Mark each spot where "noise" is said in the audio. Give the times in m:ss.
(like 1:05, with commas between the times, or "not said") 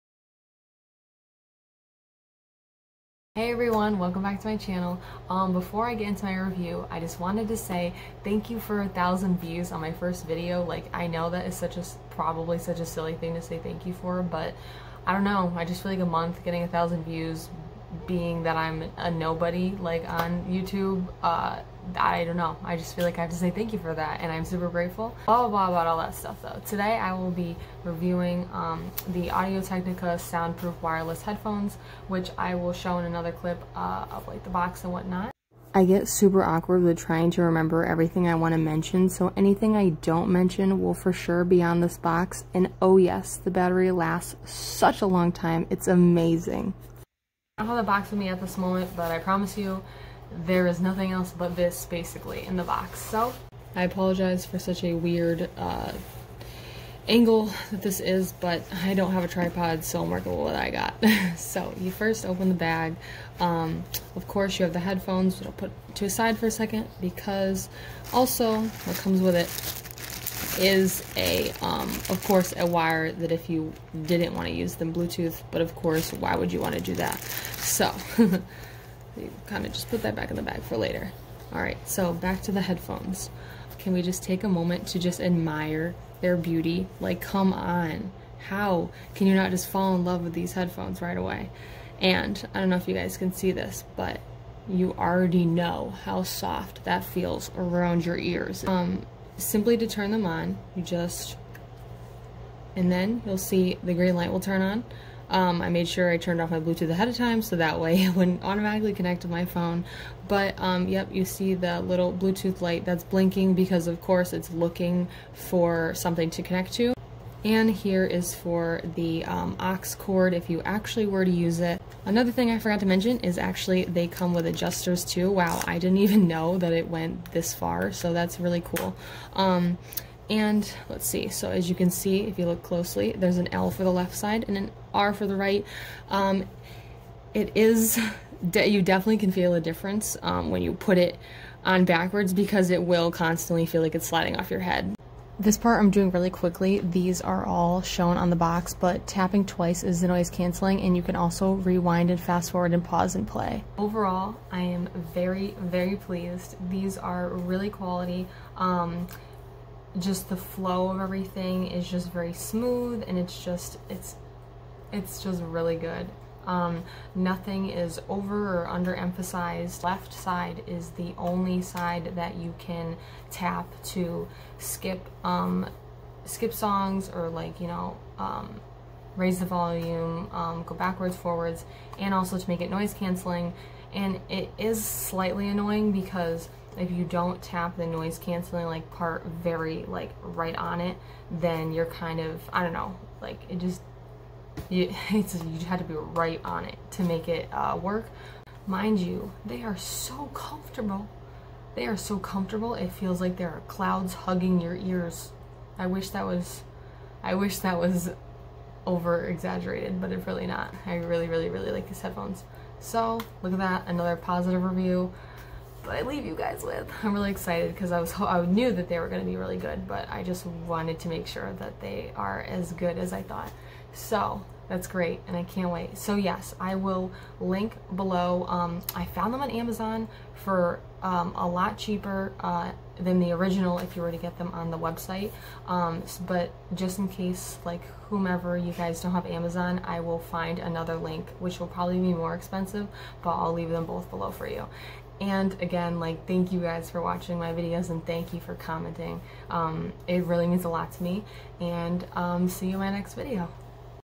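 2:30, 3:02, 3:07.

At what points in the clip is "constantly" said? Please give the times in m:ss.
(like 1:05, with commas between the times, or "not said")
2:23.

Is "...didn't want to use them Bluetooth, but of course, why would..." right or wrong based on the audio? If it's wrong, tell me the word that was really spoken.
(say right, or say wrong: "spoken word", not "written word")
right.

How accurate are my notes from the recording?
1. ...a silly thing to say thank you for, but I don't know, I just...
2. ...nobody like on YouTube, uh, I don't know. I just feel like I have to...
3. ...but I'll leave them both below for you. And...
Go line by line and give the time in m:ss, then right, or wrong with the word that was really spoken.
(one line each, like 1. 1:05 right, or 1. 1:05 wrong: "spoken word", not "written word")
1. 0:12 right
2. 0:19 right
3. 4:03 right.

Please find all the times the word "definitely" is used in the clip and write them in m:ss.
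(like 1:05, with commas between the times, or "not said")
2:18.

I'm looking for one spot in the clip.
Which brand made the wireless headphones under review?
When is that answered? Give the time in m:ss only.
0:29.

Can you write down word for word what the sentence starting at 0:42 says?
And oh yes, the battery lasts such a long time.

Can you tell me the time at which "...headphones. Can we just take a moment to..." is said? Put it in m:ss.
1:22.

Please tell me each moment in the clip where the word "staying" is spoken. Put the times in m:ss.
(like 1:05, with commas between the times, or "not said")
not said.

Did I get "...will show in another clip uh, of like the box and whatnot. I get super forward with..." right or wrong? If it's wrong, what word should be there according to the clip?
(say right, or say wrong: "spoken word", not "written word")
wrong: "awkward", not "forward".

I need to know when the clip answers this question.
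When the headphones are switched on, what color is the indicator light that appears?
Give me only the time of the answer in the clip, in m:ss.
1:43.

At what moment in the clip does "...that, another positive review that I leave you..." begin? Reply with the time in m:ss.
3:33.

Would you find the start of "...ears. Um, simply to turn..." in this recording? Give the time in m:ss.
1:38.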